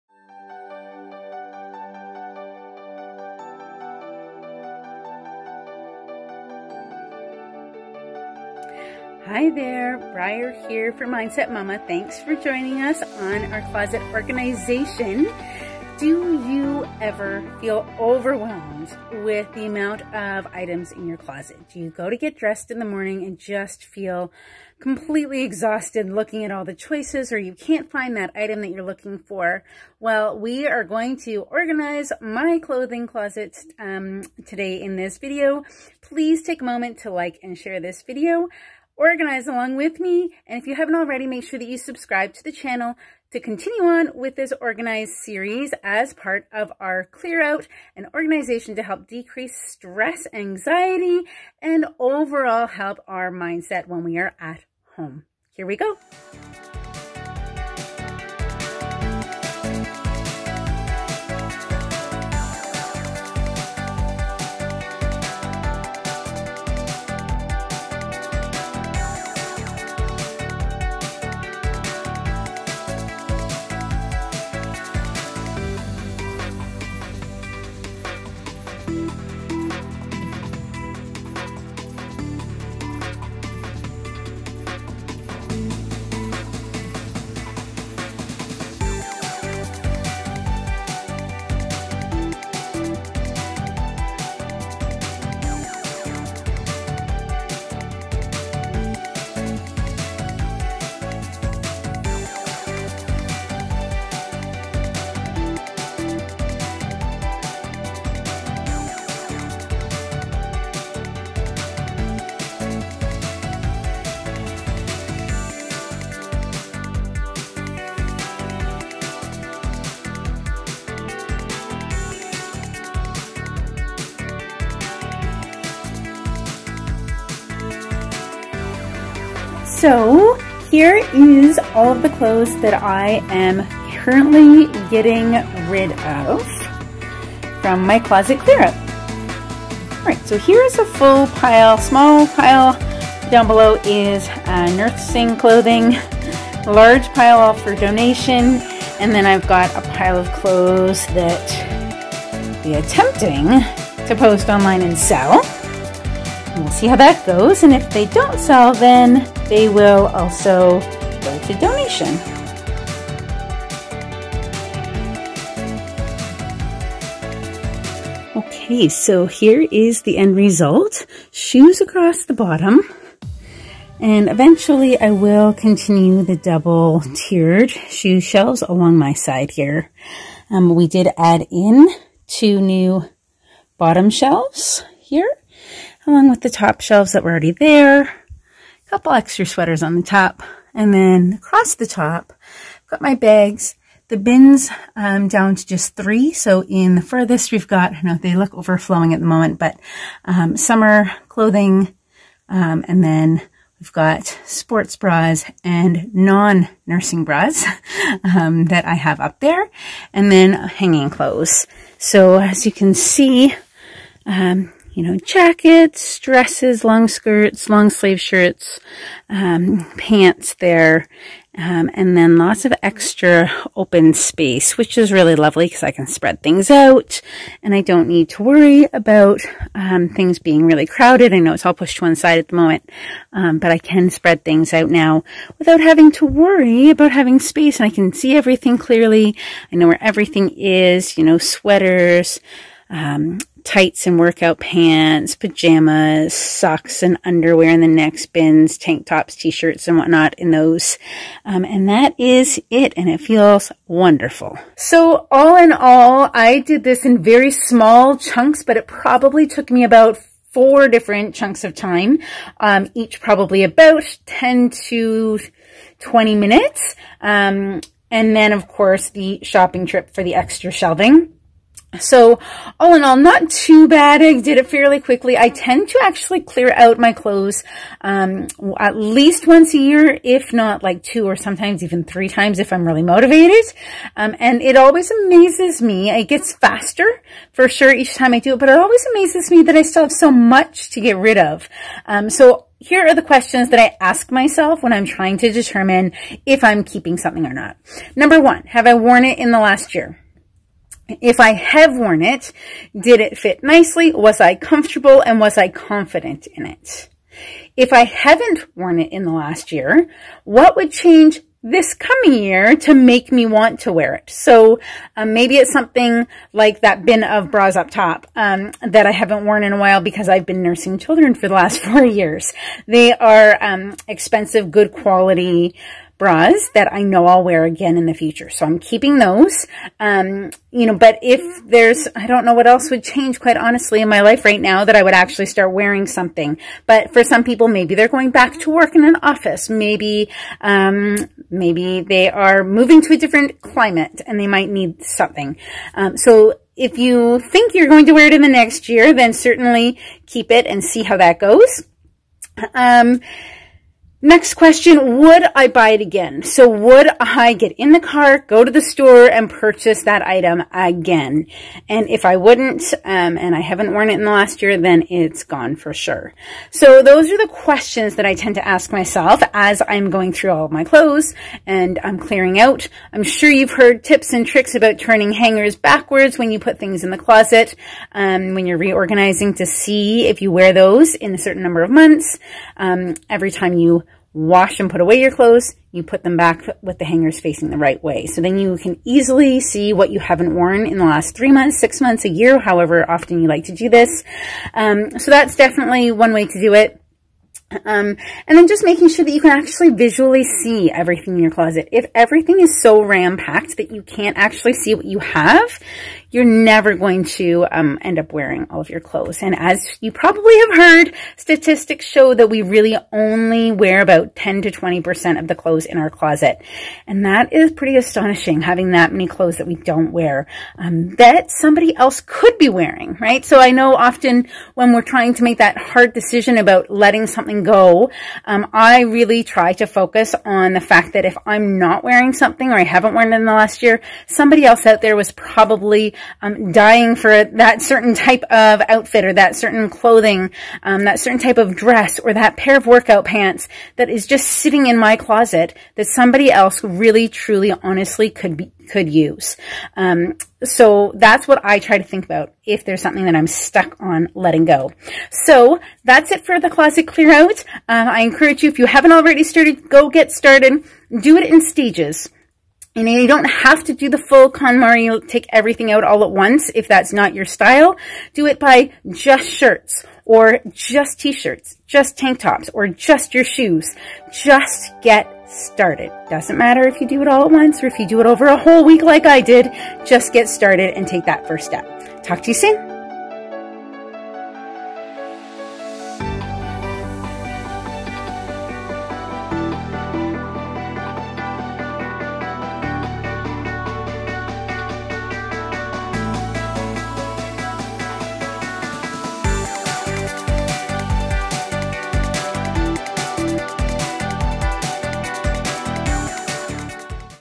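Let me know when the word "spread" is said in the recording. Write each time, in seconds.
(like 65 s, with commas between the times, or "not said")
226 s, 234 s.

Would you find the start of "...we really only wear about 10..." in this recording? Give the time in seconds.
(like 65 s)
412 s.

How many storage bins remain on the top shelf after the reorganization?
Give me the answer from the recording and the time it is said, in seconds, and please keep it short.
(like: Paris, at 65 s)
3, at 195 s.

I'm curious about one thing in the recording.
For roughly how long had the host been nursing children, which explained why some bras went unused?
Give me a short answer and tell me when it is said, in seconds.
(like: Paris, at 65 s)
4 years, at 321 s.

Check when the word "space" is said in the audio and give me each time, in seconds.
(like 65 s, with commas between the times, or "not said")
224 s, 237 s.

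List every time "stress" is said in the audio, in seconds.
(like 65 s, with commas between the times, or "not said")
49 s.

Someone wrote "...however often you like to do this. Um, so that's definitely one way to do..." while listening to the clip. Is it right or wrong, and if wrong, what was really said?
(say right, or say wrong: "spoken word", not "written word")
right.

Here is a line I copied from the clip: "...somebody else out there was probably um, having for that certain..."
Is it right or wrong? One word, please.
wrong.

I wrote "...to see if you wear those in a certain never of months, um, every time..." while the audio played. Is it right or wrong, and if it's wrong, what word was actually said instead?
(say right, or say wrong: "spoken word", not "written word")
wrong: "number", not "never".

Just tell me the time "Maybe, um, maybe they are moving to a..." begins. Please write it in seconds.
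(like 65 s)
339 s.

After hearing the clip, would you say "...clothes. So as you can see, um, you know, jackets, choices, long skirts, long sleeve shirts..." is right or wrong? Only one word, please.
wrong.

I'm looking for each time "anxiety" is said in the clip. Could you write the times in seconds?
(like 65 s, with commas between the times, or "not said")
50 s.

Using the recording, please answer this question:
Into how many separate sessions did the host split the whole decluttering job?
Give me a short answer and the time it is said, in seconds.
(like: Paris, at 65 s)
4, at 260 s.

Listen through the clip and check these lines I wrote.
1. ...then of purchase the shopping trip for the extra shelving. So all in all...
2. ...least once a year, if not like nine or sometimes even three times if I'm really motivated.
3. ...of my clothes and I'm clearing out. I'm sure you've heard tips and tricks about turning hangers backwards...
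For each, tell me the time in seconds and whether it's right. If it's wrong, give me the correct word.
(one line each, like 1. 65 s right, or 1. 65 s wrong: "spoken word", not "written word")
1. 268 s wrong: "course", not "purchase"
2. 278 s wrong: "two", not "nine"
3. 370 s right.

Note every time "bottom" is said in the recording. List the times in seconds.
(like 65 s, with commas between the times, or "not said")
172 s, 183 s.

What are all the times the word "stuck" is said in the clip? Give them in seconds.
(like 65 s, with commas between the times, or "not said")
453 s.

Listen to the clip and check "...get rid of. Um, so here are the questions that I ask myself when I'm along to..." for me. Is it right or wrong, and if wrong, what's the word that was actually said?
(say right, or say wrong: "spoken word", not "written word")
wrong: "trying", not "along".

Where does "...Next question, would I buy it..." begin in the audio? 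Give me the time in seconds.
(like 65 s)
354 s.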